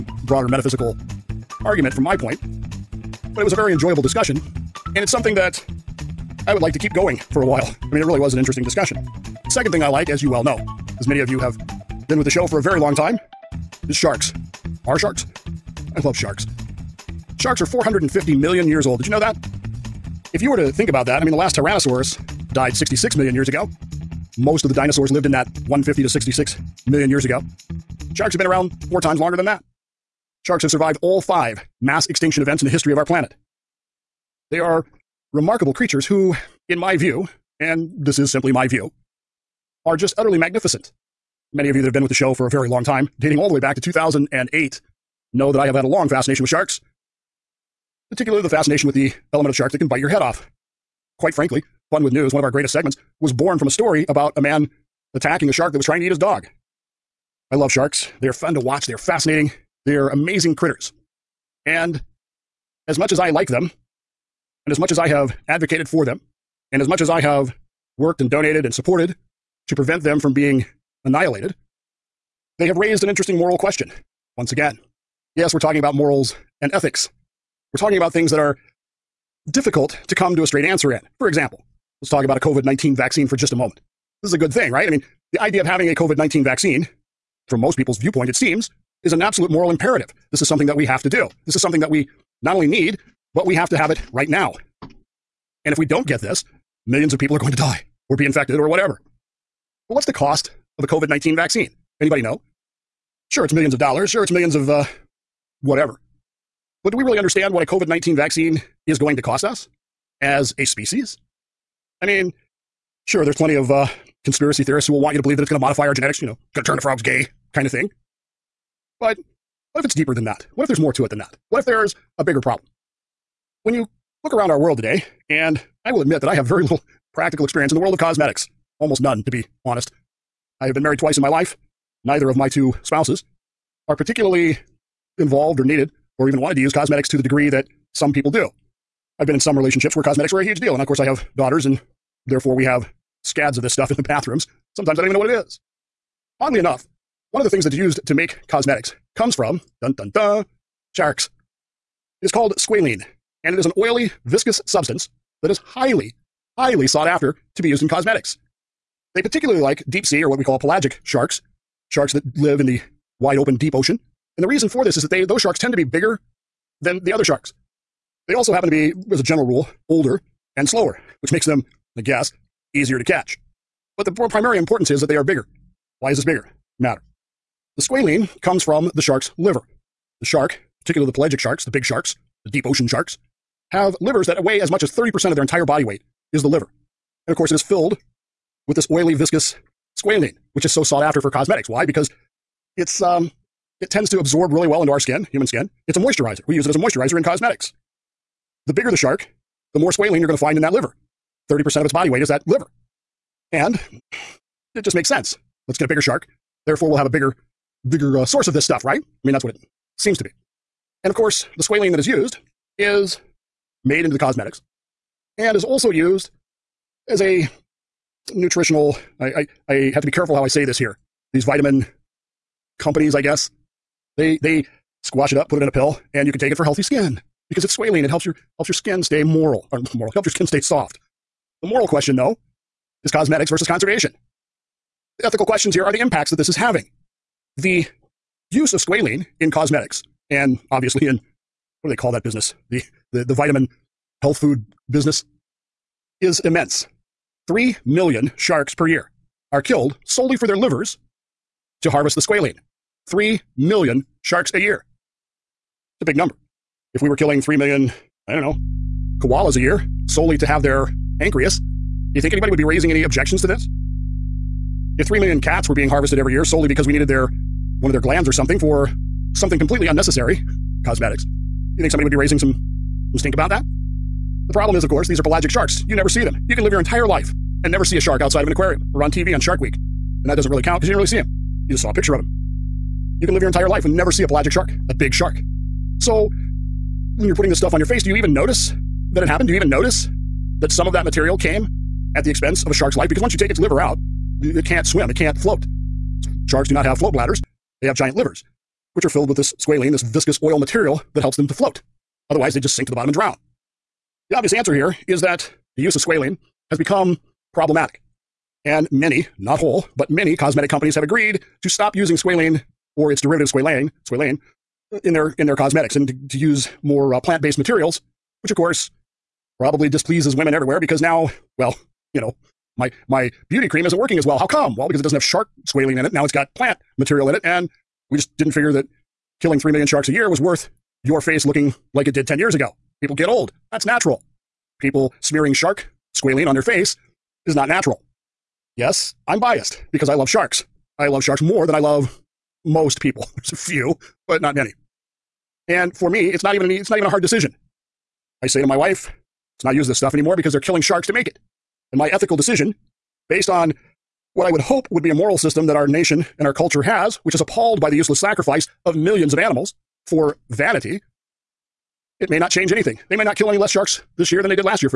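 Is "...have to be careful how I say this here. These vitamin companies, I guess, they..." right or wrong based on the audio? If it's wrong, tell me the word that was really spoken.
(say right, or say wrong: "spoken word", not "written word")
right.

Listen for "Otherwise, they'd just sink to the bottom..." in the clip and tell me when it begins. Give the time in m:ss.
5:02.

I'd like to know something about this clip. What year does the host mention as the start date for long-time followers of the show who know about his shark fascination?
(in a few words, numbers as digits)
2008.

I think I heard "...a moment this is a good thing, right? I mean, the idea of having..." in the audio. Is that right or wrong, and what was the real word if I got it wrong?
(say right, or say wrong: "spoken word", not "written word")
right.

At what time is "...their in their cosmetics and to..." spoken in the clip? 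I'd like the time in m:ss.
5:15.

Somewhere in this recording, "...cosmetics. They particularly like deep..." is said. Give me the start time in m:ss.
2:37.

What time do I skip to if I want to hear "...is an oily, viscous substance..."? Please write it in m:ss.
2:33.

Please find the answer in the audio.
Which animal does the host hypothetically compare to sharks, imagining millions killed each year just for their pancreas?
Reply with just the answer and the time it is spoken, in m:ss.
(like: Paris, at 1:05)
Koalas, at 4:19.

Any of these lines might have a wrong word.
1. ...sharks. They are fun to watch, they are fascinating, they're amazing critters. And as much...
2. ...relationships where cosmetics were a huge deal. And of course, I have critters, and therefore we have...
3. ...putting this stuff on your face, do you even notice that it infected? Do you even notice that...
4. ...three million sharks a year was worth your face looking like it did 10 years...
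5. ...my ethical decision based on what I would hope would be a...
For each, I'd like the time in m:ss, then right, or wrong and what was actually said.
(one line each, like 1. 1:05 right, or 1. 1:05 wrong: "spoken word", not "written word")
1. 0:57 right
2. 2:19 wrong: "daughters", not "critters"
3. 4:47 wrong: "happened", not "infected"
4. 5:29 right
5. 5:51 right.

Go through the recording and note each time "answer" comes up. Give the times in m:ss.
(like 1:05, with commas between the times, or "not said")
1:20, 5:04.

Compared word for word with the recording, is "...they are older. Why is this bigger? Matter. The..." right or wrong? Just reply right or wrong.
wrong.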